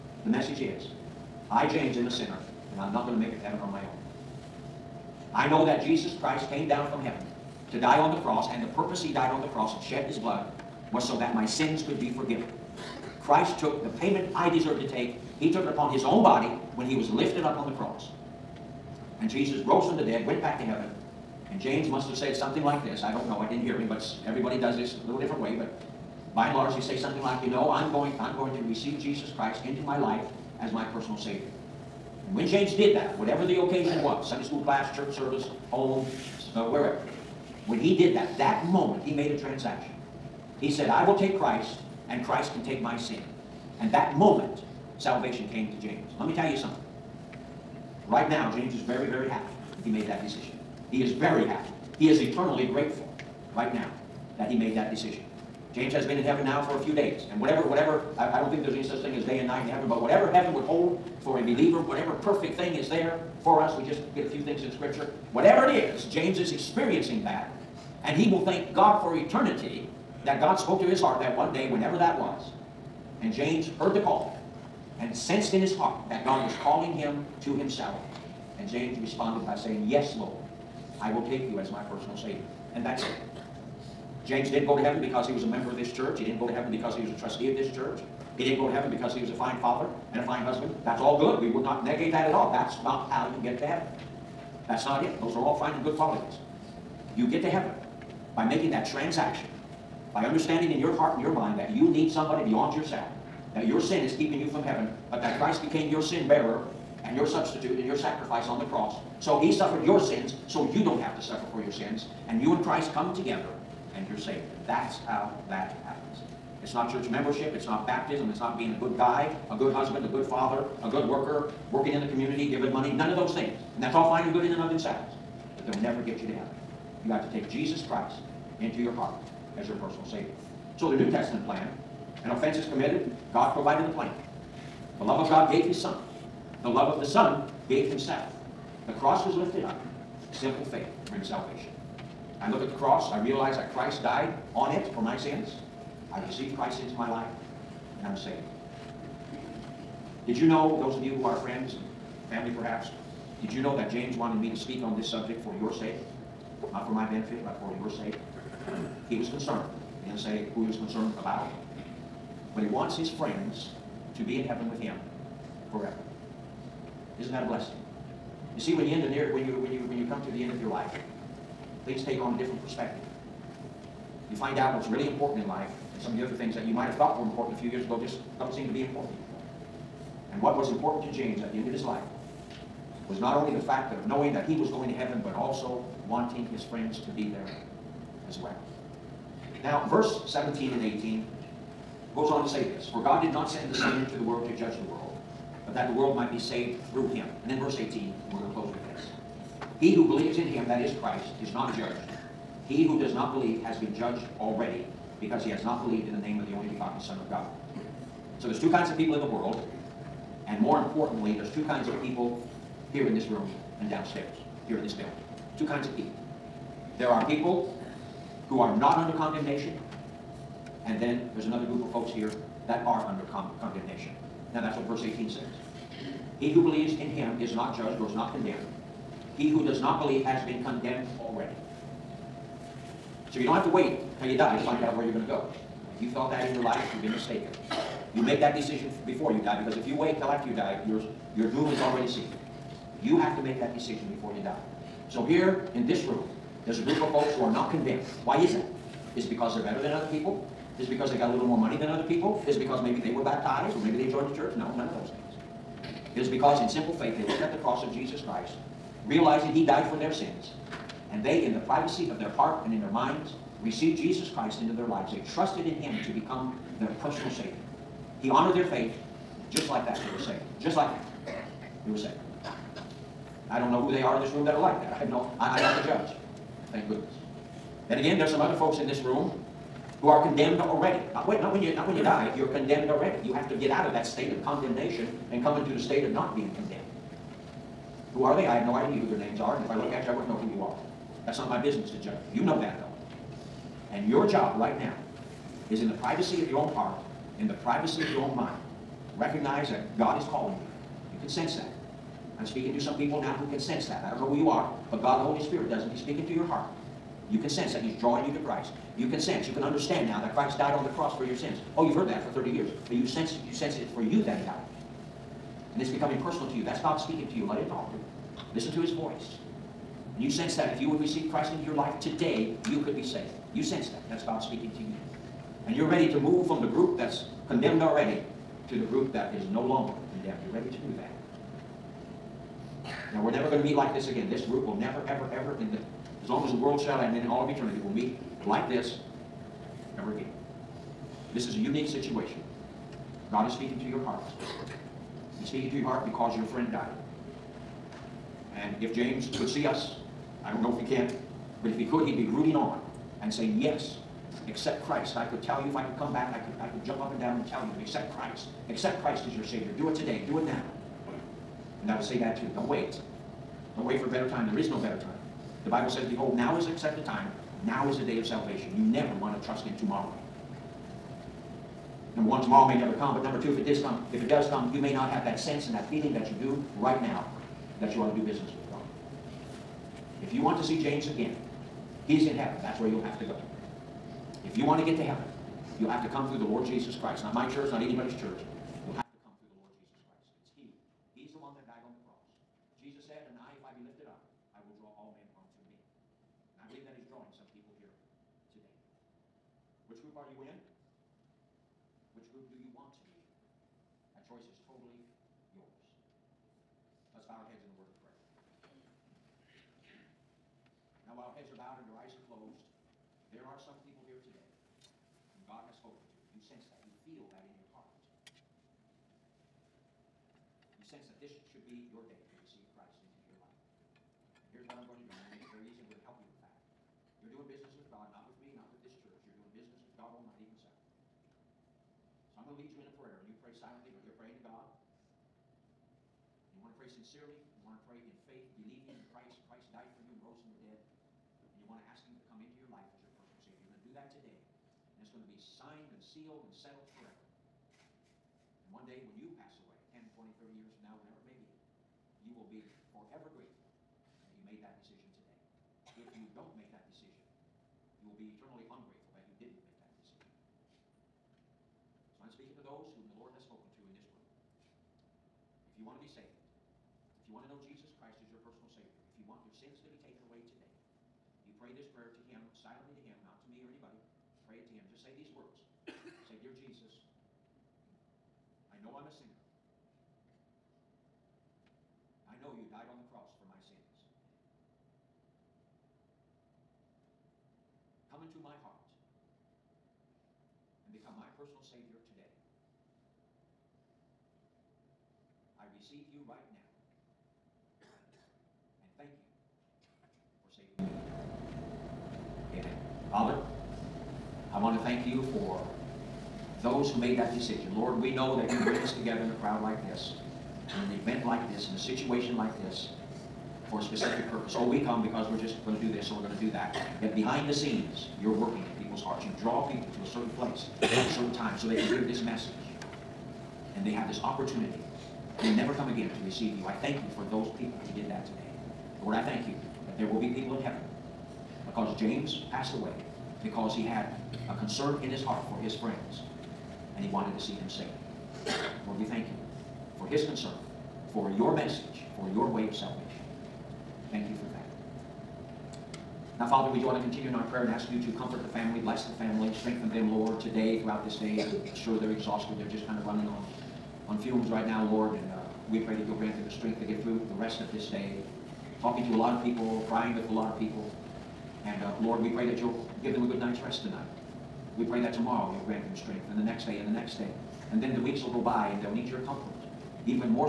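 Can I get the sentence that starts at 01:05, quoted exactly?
Whatever it is, James is experiencing that.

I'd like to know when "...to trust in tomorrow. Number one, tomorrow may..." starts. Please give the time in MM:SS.
06:09.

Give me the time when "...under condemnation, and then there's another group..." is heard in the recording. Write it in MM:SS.
03:38.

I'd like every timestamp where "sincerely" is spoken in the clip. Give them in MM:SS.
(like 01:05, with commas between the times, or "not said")
07:16.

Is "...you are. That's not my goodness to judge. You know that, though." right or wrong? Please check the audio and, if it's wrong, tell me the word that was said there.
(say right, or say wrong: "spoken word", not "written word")
wrong: "business", not "goodness".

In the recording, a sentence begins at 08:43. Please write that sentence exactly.
And they have this opportunity will never come again to receive you.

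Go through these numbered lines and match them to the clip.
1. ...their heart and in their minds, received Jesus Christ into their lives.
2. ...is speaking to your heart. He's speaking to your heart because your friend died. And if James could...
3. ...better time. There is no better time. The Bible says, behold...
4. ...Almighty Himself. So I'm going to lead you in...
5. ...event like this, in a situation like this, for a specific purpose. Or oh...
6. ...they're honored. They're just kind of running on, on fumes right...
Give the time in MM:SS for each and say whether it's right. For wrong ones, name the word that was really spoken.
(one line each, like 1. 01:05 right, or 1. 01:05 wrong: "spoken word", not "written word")
1. 04:22 right
2. 05:43 right
3. 06:04 right
4. 07:10 right
5. 08:30 right
6. 09:11 wrong: "exhausted", not "honored".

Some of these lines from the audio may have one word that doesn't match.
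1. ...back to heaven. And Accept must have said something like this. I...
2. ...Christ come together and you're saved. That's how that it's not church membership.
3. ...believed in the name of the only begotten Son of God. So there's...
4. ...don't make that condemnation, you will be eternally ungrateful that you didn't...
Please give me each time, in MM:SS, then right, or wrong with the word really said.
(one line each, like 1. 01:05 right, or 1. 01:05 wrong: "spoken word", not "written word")
1. 00:20 wrong: "James", not "Accept"
2. 01:52 right
3. 03:25 right
4. 07:36 wrong: "decision", not "condemnation".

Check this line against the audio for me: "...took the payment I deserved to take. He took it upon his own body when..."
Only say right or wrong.
right.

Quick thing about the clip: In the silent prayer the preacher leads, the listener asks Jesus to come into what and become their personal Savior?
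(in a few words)
my heart.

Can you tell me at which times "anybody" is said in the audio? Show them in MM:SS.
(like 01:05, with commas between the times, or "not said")
06:27, 07:53.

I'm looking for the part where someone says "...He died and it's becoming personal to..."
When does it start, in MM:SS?
05:14.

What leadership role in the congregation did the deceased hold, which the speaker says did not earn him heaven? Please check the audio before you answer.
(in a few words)
trustee.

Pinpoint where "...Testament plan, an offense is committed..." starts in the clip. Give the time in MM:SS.
02:11.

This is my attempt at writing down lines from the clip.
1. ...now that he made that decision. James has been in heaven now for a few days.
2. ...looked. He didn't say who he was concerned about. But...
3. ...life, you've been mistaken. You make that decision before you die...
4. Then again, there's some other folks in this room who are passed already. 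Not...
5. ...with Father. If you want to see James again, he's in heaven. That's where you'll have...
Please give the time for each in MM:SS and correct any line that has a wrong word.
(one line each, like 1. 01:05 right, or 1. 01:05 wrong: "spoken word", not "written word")
1. 00:53 right
2. 02:39 wrong: "concerned", not "looked"
3. 03:56 right
4. 04:37 wrong: "condemned", not "passed"
5. 06:18 wrong: "God", not "Father".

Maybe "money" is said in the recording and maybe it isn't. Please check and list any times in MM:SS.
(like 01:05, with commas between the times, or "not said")
02:02, 04:11.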